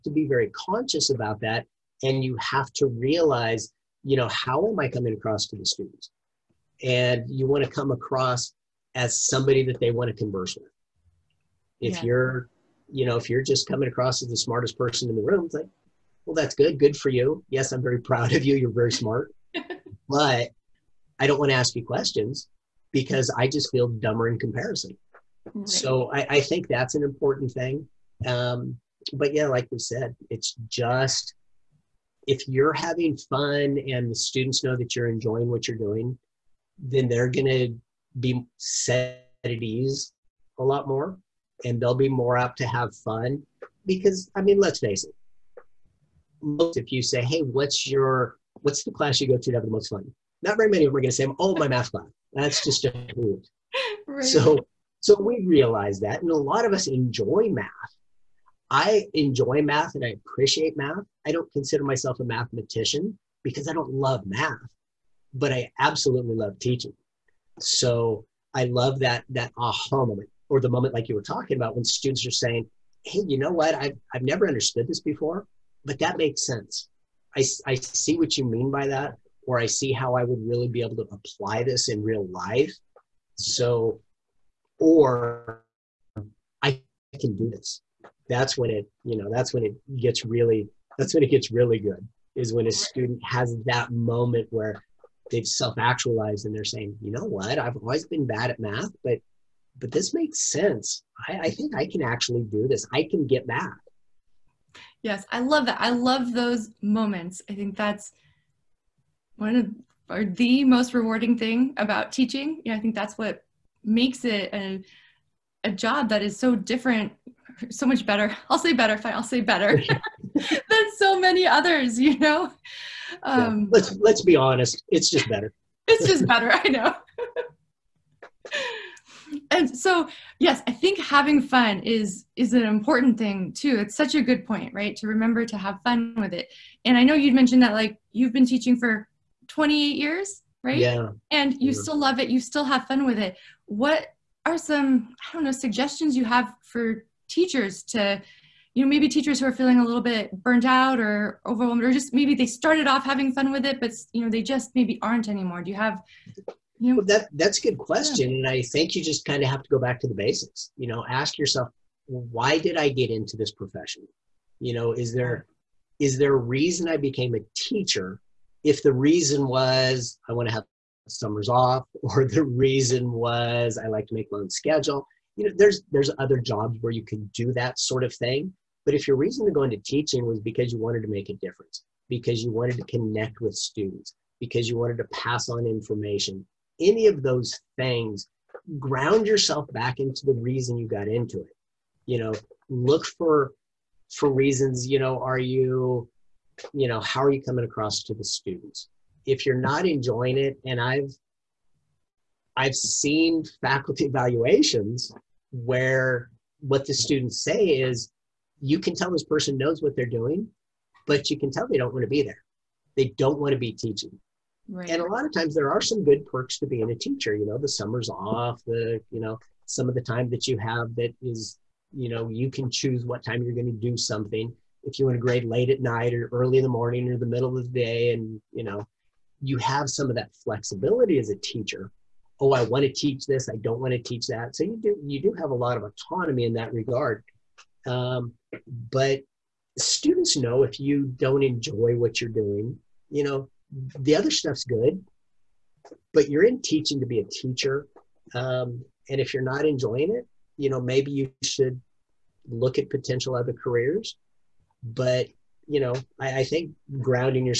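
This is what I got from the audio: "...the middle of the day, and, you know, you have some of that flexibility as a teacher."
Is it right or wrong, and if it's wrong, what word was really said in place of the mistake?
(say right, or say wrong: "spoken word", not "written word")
right.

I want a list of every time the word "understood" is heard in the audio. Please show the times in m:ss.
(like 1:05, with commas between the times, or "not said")
1:14.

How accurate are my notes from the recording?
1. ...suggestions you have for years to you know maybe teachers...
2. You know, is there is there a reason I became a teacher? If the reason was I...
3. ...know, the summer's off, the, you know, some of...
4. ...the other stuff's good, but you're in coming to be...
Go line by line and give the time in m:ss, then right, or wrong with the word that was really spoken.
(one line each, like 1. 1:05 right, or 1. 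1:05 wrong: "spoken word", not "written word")
1. 2:25 wrong: "teachers", not "years"
2. 2:44 right
3. 3:37 right
4. 4:03 wrong: "teaching", not "coming".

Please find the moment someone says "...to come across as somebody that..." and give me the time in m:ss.
0:07.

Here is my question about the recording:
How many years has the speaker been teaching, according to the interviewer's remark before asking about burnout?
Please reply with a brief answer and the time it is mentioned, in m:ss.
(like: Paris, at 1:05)
28, at 2:19.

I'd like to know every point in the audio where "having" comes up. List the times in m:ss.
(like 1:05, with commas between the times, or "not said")
0:32, 2:10, 2:33.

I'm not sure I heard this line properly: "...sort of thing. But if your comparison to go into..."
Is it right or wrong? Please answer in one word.
wrong.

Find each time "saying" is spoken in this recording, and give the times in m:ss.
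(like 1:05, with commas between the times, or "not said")
1:12, 1:36.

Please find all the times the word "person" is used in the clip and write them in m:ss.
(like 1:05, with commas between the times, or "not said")
0:14, 3:29.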